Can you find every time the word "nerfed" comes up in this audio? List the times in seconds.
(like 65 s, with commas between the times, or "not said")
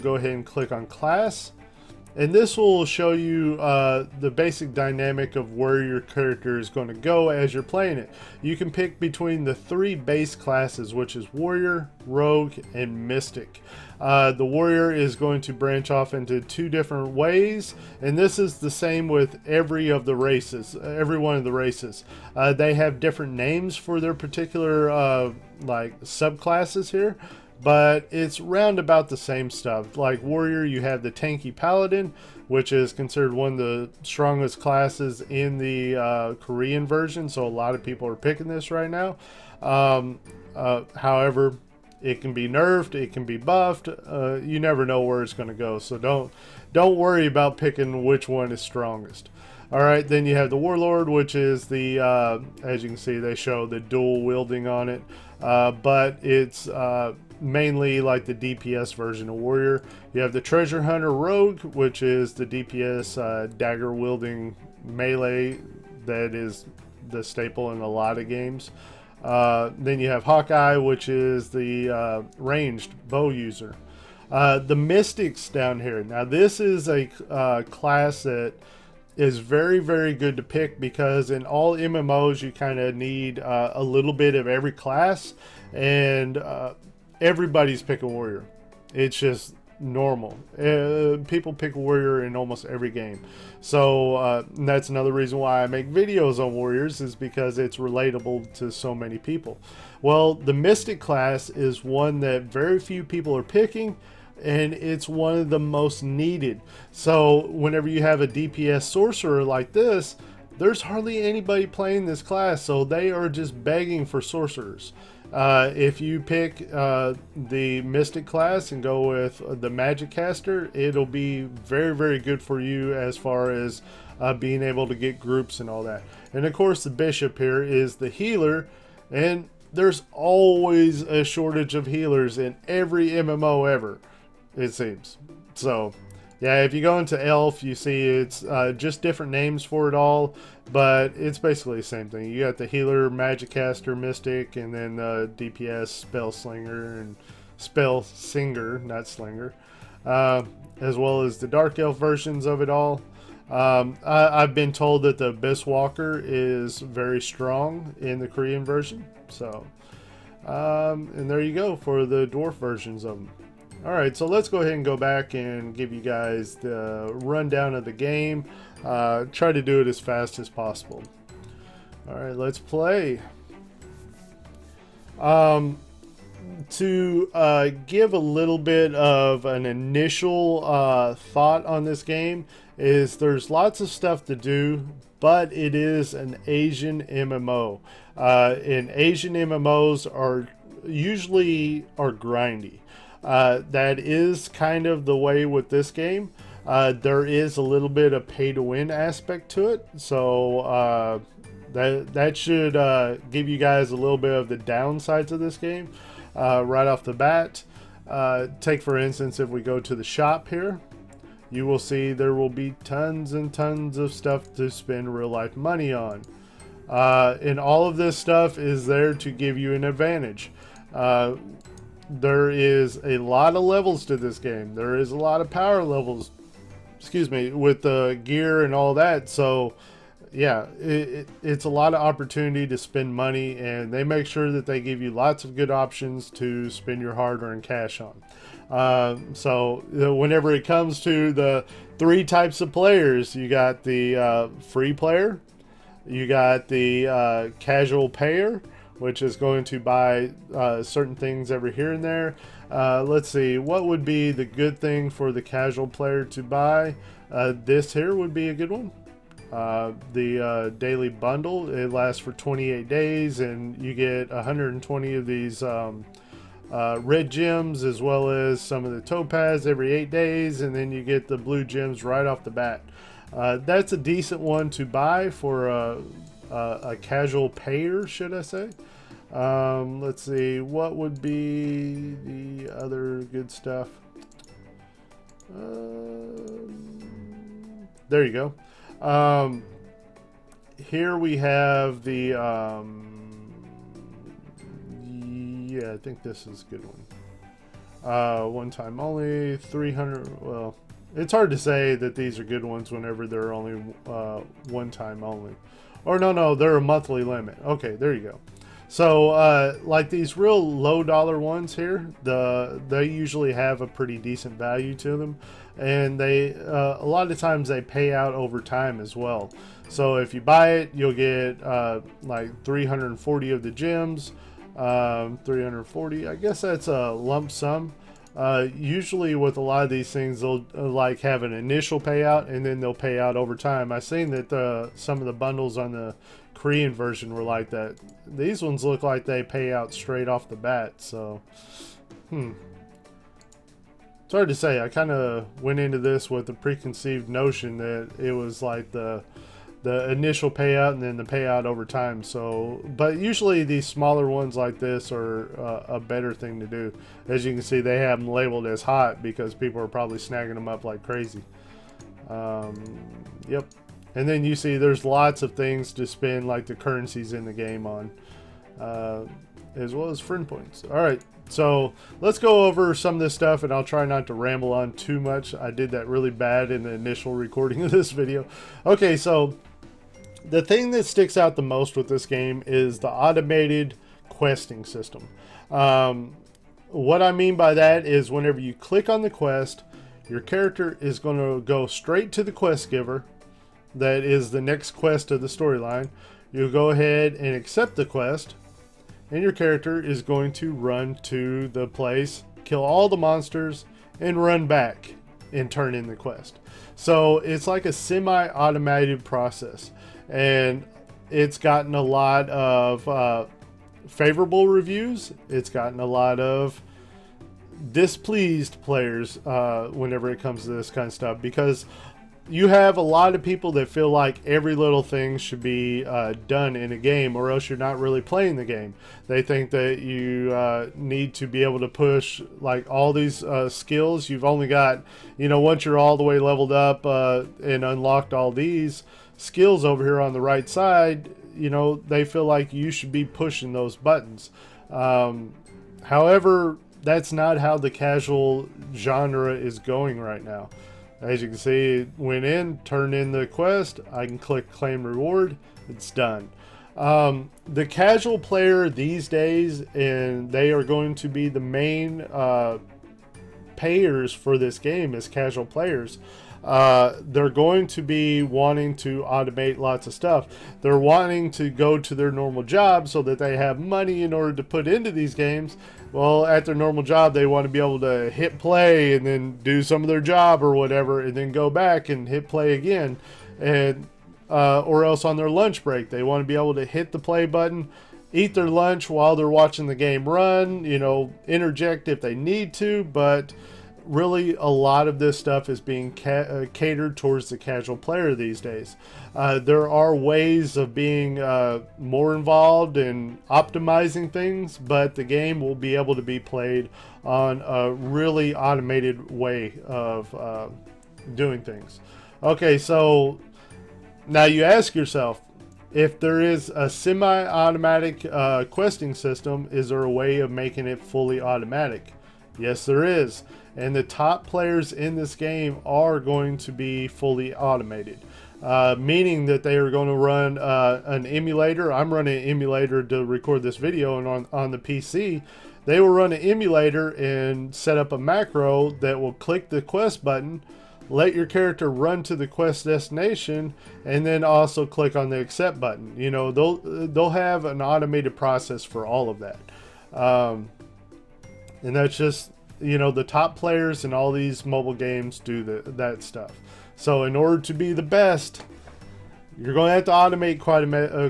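42 s.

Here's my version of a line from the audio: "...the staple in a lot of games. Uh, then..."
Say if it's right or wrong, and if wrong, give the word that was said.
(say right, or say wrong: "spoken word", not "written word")
right.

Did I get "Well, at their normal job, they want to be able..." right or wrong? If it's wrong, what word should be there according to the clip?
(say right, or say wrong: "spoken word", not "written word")
right.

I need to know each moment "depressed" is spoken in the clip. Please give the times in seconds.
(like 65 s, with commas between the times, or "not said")
not said.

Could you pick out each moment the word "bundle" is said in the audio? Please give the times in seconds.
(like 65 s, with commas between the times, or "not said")
261 s, 335 s.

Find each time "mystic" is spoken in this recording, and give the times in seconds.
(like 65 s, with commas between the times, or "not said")
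13 s, 74 s, 100 s, 117 s, 143 s.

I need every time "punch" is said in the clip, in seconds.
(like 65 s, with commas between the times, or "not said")
not said.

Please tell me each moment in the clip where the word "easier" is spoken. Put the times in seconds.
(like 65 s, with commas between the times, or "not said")
not said.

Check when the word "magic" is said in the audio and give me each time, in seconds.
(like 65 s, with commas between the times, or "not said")
119 s, 143 s.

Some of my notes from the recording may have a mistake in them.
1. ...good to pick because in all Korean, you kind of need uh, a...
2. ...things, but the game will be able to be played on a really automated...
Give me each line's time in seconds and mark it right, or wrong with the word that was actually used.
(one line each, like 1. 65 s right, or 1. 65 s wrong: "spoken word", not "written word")
1. 80 s wrong: "MMOs", not "Korean"
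2. 504 s right.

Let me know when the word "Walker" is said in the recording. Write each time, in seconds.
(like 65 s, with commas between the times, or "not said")
155 s.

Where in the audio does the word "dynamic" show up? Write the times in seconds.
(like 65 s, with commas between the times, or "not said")
4 s.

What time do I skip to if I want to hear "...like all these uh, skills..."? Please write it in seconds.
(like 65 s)
432 s.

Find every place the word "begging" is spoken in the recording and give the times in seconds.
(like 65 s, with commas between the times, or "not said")
113 s.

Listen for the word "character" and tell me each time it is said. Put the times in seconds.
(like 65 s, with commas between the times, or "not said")
6 s, 390 s, 399 s, 541 s.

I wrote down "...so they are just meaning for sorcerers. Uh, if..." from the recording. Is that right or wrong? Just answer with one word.
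wrong.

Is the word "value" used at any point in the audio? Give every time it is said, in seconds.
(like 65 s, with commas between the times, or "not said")
314 s.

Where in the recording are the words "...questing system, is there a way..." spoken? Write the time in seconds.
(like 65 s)
518 s.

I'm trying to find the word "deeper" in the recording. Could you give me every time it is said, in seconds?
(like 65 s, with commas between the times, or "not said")
not said.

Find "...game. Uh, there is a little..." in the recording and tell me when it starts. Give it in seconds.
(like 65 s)
195 s.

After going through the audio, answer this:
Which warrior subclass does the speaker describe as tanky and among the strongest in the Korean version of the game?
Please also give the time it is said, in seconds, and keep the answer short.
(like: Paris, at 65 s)
Paladin, at 31 s.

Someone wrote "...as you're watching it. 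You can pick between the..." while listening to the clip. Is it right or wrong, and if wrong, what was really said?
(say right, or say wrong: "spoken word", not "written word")
wrong: "playing", not "watching".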